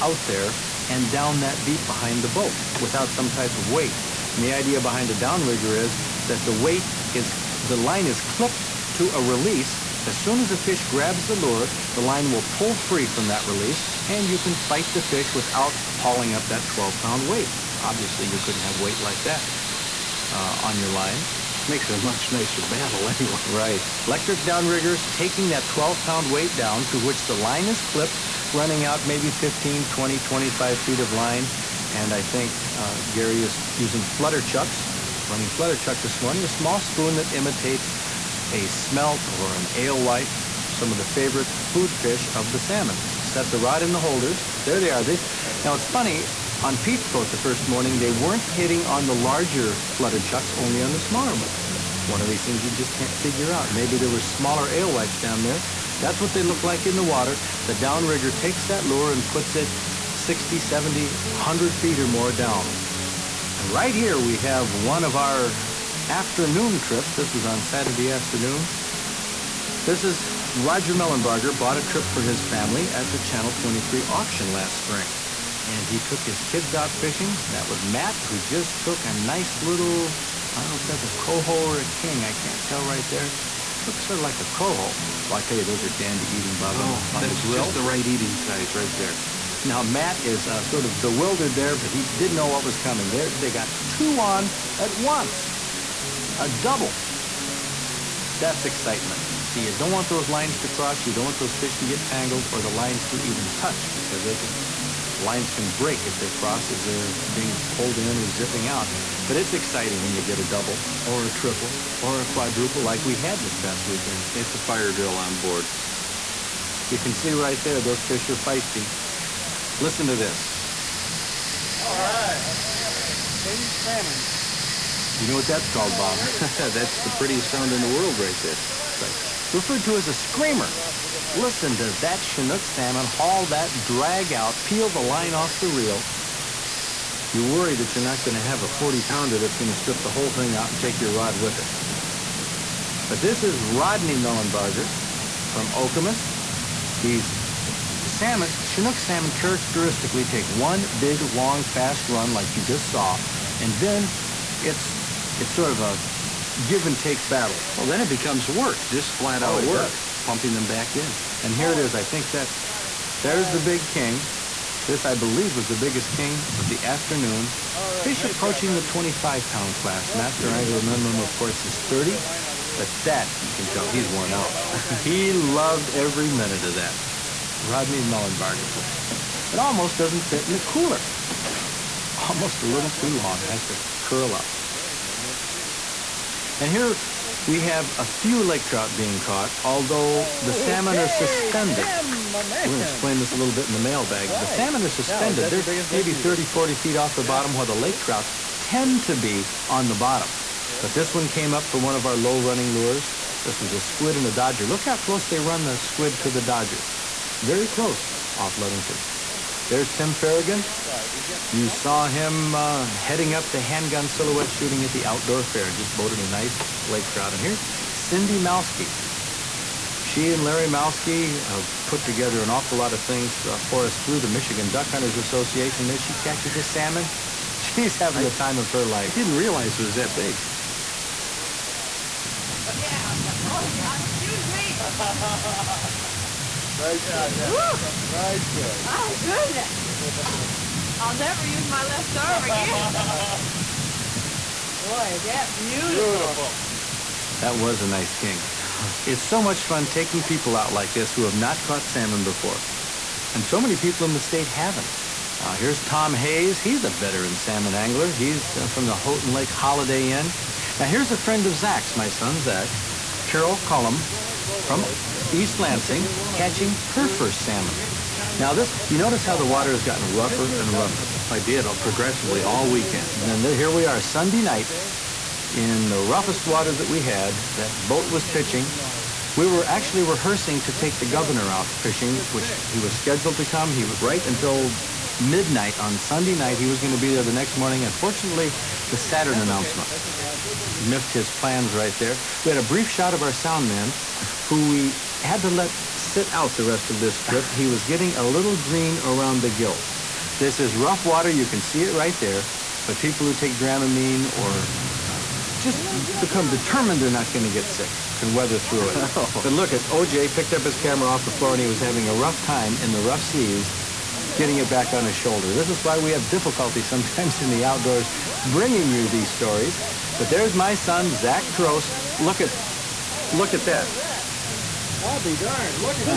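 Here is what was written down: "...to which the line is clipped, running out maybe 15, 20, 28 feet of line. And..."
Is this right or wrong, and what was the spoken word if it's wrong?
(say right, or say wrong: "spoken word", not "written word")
wrong: "25", not "28".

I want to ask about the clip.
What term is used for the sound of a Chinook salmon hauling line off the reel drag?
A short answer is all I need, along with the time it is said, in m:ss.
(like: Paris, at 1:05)
A screamer, at 2:10.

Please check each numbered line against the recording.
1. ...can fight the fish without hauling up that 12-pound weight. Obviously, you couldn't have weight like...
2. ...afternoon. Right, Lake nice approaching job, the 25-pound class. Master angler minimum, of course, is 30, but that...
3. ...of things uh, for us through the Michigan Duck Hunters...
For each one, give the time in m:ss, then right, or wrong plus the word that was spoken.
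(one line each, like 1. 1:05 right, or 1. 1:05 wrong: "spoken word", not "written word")
1. 0:14 right
2. 2:46 wrong: "Fish", not "Lake"
3. 3:42 right.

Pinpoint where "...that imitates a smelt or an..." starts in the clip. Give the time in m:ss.
0:37.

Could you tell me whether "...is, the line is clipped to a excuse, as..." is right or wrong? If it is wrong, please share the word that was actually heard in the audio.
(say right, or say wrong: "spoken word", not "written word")
wrong: "release", not "excuse".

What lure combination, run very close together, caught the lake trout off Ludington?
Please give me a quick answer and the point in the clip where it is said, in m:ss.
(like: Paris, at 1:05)
A squid and a dodger, at 3:23.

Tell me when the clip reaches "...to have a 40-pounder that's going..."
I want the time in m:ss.
2:18.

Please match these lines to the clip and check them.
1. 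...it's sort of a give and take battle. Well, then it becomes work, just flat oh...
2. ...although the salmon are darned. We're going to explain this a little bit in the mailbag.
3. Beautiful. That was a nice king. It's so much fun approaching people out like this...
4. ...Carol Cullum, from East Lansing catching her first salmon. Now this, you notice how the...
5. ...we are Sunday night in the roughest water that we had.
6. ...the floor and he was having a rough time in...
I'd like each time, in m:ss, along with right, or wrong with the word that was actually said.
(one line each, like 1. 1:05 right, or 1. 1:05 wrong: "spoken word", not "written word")
1. 2:35 right
2. 3:09 wrong: "suspended", not "darned"
3. 4:06 wrong: "taking", not "approaching"
4. 4:23 right
5. 4:33 right
6. 5:11 right.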